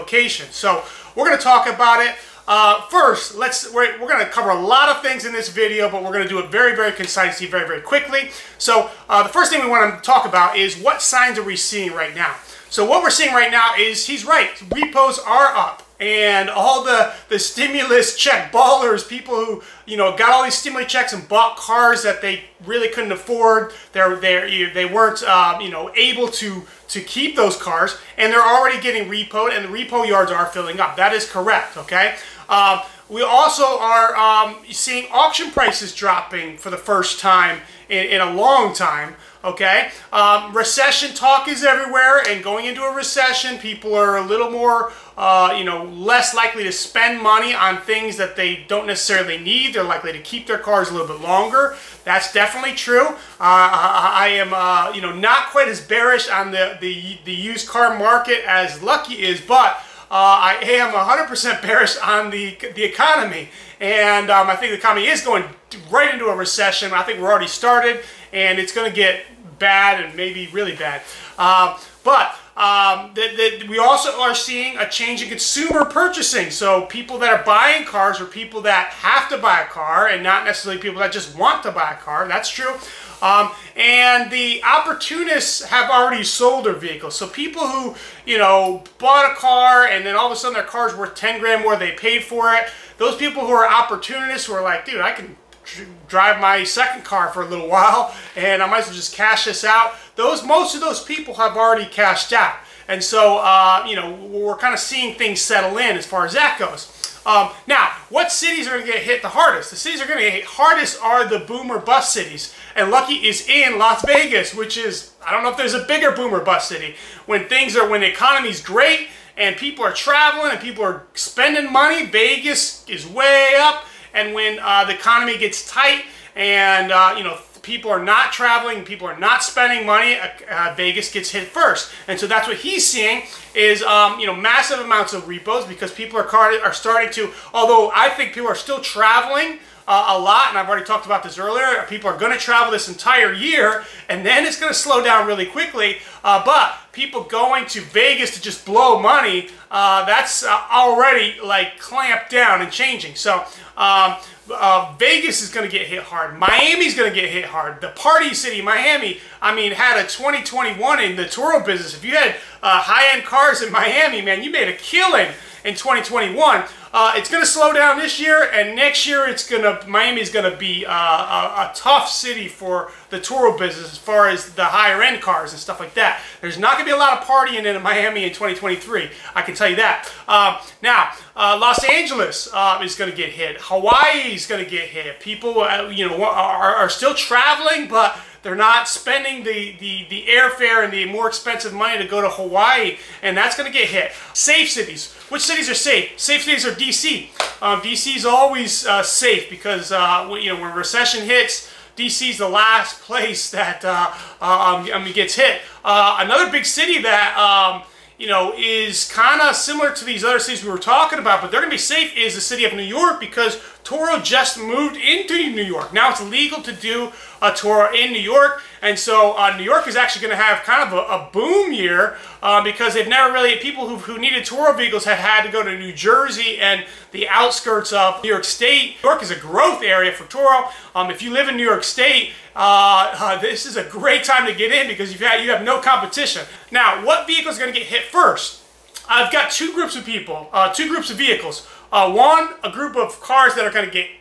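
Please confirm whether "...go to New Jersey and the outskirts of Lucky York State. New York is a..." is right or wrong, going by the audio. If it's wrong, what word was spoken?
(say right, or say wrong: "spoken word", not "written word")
wrong: "New", not "Lucky".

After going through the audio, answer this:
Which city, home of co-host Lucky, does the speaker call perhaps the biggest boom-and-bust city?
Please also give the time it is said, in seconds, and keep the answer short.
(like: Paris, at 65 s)
Las Vegas, at 113 s.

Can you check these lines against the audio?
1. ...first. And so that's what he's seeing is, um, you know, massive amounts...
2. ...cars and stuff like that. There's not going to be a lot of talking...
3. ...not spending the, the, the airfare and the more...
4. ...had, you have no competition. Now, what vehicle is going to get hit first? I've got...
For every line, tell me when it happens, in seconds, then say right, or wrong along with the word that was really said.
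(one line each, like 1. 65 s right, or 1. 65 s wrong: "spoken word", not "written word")
1. 131 s right
2. 175 s wrong: "partying", not "talking"
3. 188 s right
4. 235 s right.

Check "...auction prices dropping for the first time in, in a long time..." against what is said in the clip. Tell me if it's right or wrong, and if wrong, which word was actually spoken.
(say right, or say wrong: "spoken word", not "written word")
right.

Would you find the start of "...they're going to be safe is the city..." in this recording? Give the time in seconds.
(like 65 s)
211 s.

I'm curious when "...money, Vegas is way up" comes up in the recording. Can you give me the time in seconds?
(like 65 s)
121 s.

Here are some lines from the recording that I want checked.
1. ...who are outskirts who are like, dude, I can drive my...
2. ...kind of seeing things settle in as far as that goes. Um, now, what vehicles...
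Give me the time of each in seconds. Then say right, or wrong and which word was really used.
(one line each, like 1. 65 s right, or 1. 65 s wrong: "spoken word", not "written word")
1. 93 s wrong: "opportunists", not "outskirts"
2. 104 s wrong: "cities", not "vehicles".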